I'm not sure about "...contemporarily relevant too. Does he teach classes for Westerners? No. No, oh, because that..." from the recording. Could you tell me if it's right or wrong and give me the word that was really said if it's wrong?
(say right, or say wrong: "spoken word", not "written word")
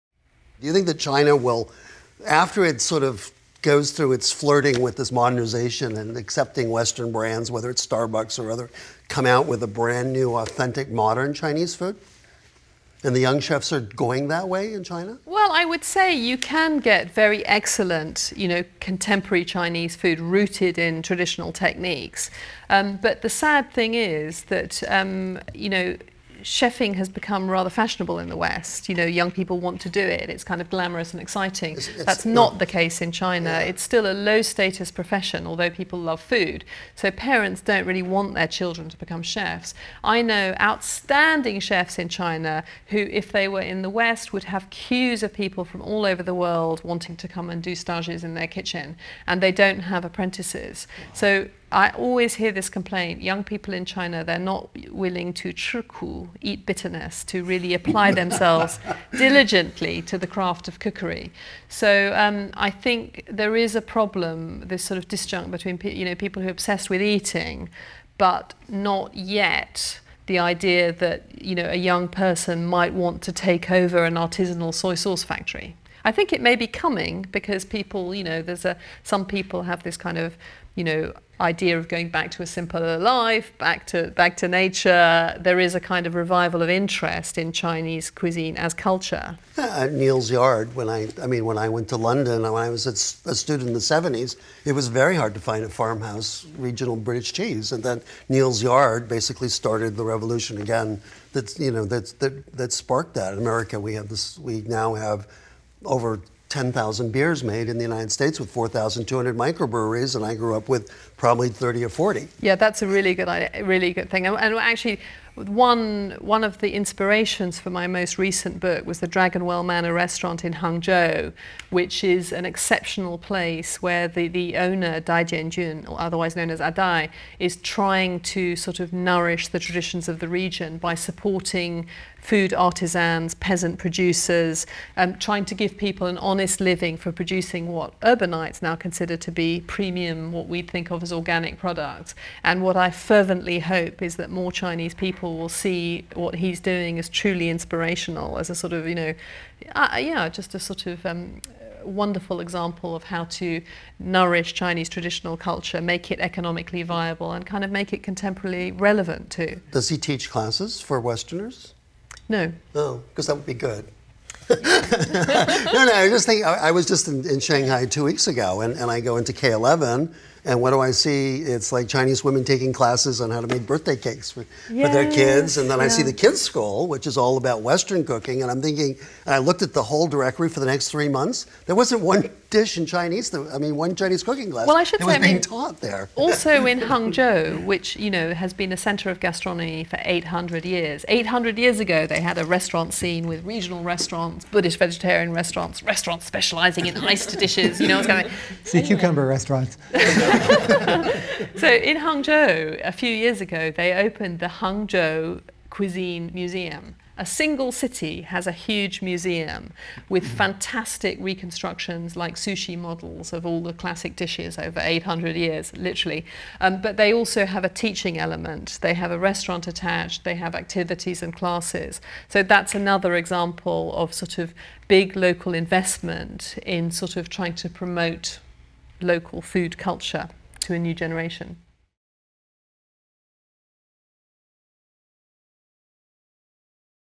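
right.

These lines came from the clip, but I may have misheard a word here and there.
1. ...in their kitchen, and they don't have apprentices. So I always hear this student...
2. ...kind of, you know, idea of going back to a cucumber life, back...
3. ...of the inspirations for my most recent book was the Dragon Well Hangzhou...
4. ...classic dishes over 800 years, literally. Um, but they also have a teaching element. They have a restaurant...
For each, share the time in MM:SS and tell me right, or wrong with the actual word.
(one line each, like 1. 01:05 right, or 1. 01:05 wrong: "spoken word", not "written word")
1. 00:48 wrong: "complaint", not "student"
2. 01:19 wrong: "simpler", not "cucumber"
3. 01:56 wrong: "Manor", not "Hangzhou"
4. 03:33 right.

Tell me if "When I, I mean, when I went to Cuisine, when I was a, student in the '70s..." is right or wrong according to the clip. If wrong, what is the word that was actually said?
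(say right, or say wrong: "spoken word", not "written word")
wrong: "London", not "Cuisine".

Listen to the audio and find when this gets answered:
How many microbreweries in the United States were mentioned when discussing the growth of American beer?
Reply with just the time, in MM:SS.
01:48.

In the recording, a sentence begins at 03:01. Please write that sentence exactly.
There wasn't one dish in Chinese, that, I mean, one Chinese cooking class.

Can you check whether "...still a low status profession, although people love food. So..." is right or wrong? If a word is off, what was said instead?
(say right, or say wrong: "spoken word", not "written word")
right.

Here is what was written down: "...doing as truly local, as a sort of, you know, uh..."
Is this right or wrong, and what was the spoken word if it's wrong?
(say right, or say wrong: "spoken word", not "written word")
wrong: "inspirational", not "local".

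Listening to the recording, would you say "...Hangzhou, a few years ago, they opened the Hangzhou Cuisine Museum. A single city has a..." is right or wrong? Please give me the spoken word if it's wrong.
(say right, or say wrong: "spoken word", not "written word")
right.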